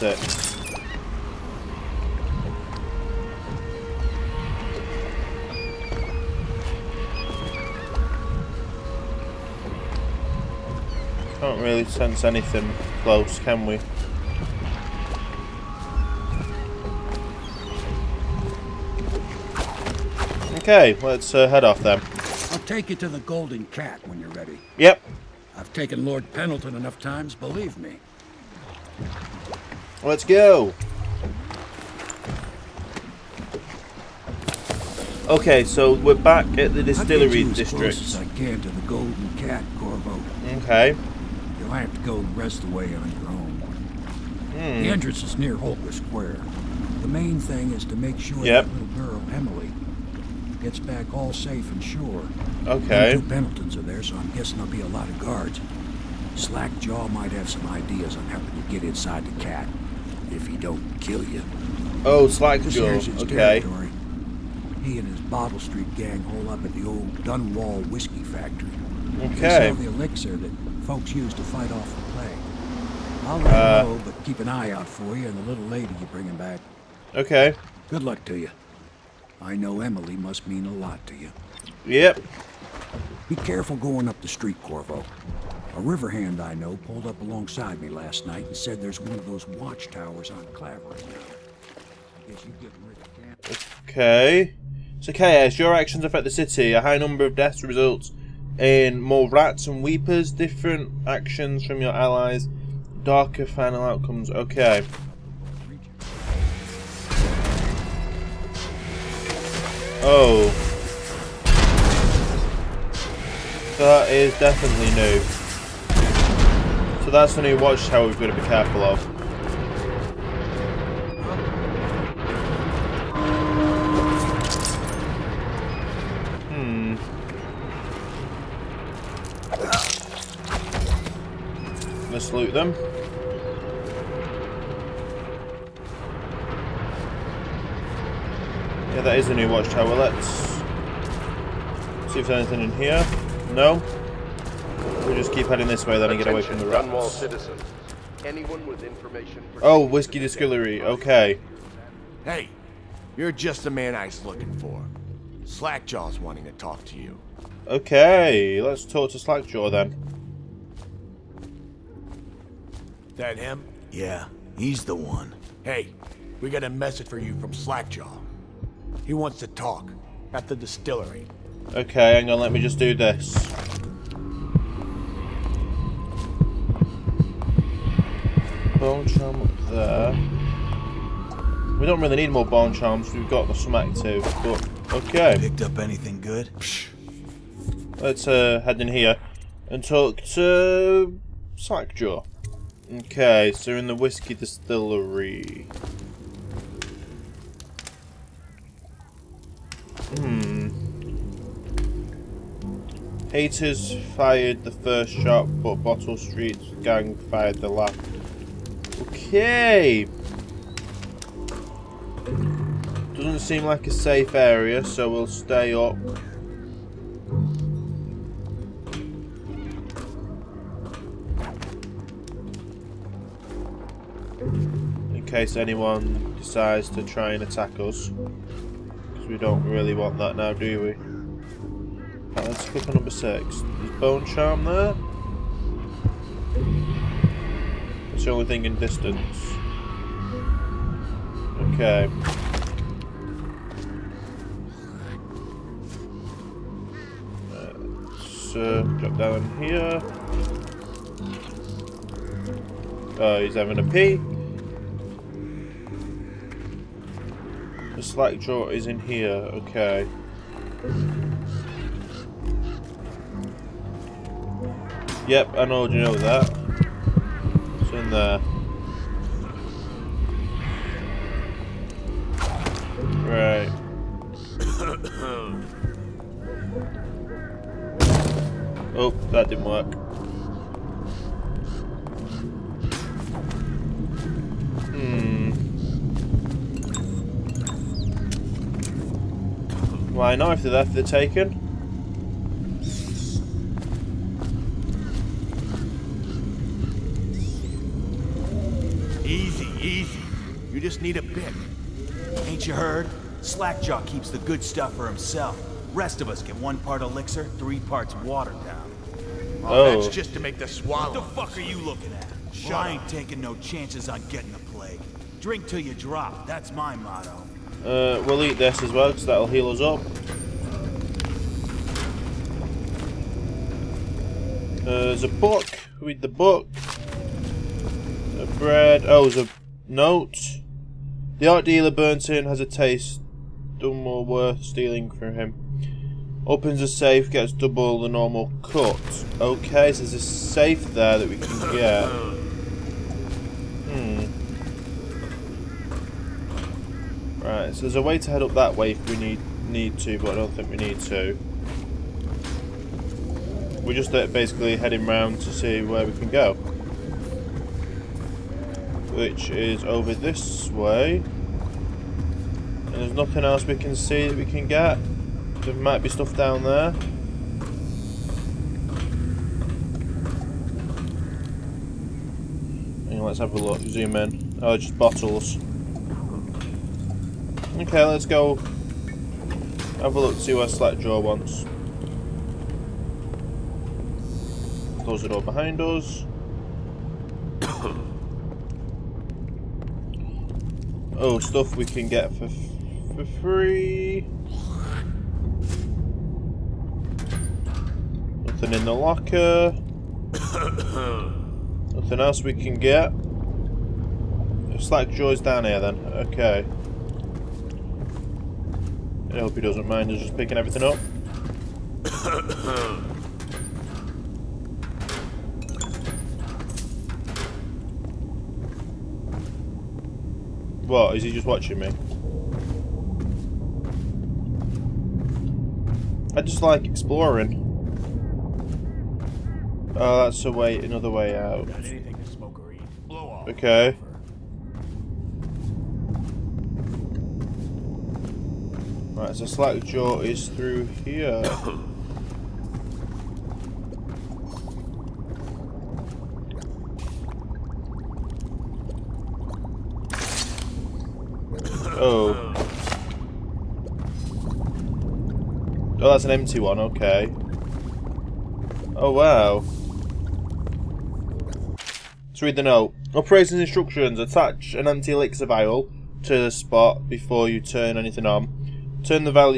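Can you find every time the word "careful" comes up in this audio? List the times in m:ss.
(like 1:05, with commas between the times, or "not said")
1:23, 1:58.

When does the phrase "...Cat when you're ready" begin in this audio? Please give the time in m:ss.
0:23.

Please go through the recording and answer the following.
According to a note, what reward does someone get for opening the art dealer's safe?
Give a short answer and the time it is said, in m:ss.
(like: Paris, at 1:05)
double the normal cut, at 5:37.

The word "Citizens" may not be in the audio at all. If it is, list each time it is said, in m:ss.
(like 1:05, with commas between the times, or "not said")
2:27.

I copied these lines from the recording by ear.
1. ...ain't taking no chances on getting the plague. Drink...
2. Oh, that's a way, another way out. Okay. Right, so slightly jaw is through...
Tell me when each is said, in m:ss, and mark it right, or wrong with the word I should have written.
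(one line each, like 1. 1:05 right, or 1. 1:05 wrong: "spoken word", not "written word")
1. 5:12 right
2. 7:09 right.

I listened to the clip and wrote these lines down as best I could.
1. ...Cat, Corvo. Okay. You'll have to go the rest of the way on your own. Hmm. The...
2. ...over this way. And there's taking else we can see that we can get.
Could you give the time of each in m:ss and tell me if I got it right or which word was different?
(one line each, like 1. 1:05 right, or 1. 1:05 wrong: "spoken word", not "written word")
1. 0:39 right
2. 5:59 wrong: "nothing", not "taking".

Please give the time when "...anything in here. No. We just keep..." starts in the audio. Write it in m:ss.
2:22.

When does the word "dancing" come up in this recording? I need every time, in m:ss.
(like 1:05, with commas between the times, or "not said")
not said.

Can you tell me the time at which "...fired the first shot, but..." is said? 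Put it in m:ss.
3:24.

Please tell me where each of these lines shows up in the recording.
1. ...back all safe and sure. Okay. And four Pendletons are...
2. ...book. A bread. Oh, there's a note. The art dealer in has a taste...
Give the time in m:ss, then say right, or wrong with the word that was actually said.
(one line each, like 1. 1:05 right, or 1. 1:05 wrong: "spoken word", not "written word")
1. 0:50 wrong: "two", not "four"
2. 5:26 right.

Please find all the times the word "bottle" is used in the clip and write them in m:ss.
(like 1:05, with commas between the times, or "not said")
1:05, 3:25, 6:14.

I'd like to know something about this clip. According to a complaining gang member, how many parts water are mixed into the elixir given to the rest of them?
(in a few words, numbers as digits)
3.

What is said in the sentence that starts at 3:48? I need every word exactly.
Because we don't really want that now, do we?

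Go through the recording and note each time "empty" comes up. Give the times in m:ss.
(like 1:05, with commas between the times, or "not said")
7:36, 7:44.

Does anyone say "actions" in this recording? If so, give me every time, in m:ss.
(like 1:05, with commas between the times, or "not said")
1:35, 1:41.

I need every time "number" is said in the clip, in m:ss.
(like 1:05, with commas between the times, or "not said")
1:36, 3:52.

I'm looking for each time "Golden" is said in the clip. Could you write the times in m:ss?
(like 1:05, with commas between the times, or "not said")
0:23, 0:38.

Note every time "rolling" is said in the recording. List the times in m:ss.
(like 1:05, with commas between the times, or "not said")
not said.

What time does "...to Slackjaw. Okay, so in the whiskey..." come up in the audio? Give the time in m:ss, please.
3:10.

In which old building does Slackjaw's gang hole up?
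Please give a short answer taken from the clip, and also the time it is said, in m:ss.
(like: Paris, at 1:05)
Dunwall Whiskey Factory, at 1:06.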